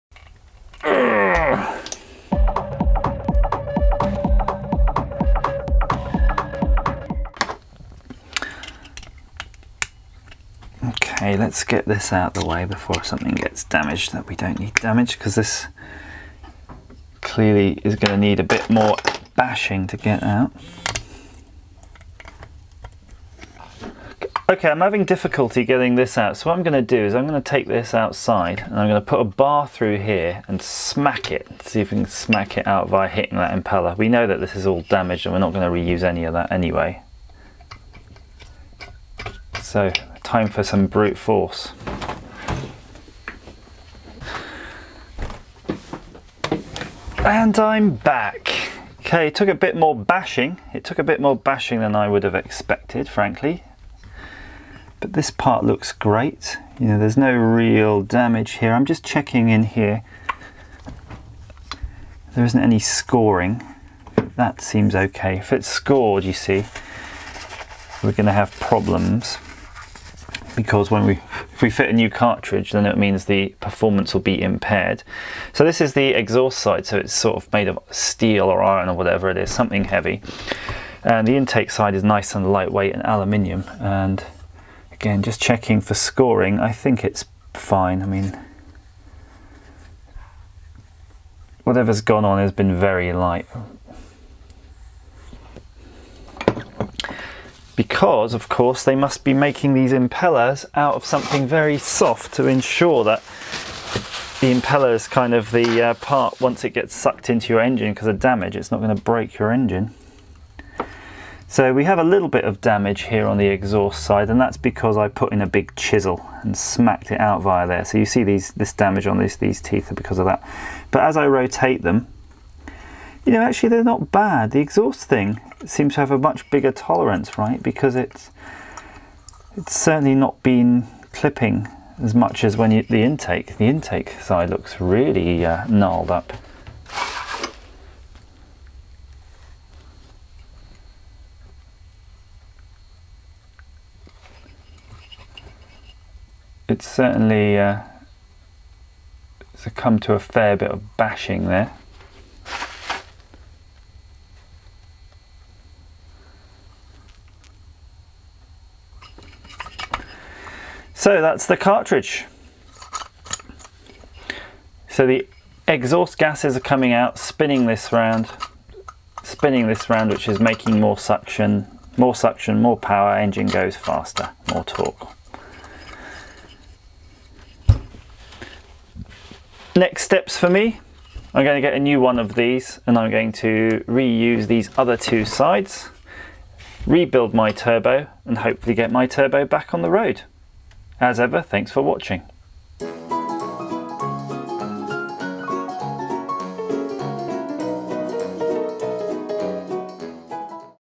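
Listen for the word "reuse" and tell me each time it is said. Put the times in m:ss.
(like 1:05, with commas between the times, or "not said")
0:35, 3:03.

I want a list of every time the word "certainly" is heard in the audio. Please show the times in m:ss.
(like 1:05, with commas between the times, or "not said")
2:09, 2:26.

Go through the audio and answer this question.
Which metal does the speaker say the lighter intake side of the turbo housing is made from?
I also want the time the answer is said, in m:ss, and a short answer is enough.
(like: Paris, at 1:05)
Aluminium, at 1:23.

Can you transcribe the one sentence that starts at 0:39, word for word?
So time for some brute force.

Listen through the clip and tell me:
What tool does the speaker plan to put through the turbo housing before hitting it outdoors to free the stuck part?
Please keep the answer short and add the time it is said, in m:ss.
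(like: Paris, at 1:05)
A bar, at 0:29.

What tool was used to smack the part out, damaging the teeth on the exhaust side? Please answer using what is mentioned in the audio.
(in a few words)
A big chisel.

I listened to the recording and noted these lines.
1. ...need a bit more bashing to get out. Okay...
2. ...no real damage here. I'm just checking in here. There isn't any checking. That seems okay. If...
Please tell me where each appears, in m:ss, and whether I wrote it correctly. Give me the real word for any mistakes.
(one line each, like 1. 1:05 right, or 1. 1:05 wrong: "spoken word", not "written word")
1. 0:18 right
2. 0:57 wrong: "scoring", not "checking".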